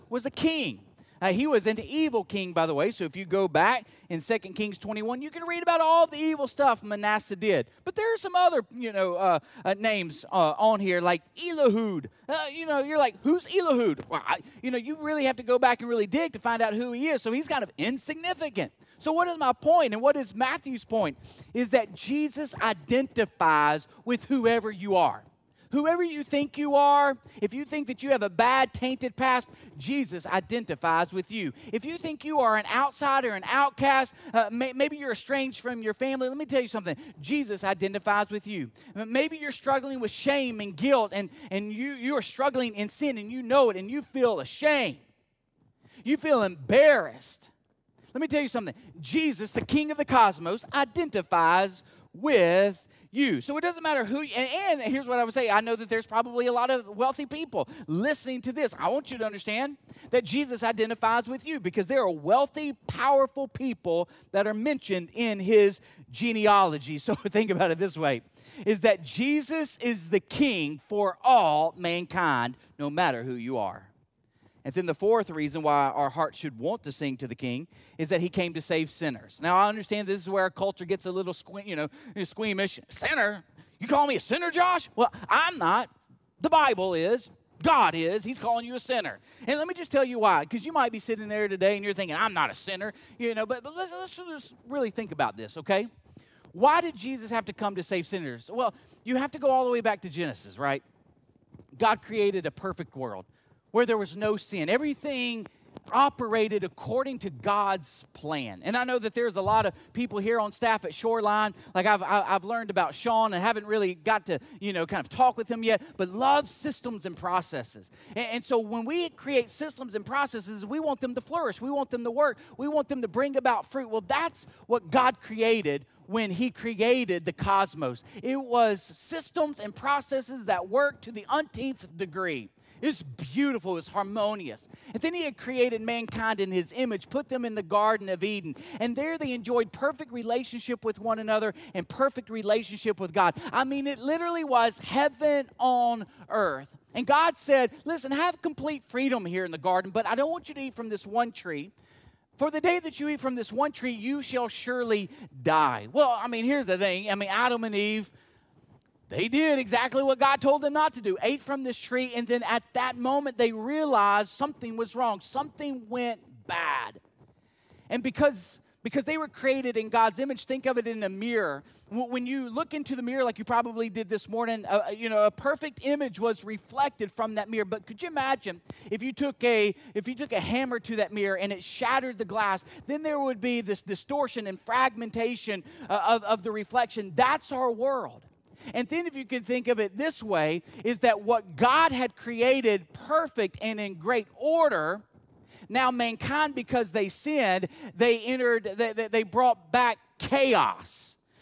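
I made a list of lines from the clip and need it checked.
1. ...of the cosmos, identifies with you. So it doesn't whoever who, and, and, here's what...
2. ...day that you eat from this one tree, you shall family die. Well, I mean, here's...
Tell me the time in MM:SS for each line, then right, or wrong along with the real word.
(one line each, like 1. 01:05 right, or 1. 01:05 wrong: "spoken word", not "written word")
1. 00:49 wrong: "matter", not "whoever"
2. 02:32 wrong: "surely", not "family".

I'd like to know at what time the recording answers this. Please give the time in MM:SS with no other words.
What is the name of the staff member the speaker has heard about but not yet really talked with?
01:52.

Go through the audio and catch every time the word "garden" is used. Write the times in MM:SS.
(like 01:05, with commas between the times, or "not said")
02:17, 02:29.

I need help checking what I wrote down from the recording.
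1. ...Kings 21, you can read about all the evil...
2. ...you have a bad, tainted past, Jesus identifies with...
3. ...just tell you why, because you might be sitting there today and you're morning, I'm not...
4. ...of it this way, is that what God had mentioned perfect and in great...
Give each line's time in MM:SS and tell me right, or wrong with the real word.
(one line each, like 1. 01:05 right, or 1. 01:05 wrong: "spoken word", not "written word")
1. 00:04 right
2. 00:28 right
3. 01:29 wrong: "thinking", not "morning"
4. 03:09 wrong: "created", not "mentioned".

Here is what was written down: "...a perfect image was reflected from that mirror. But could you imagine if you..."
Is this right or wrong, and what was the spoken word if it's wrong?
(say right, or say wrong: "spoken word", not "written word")
right.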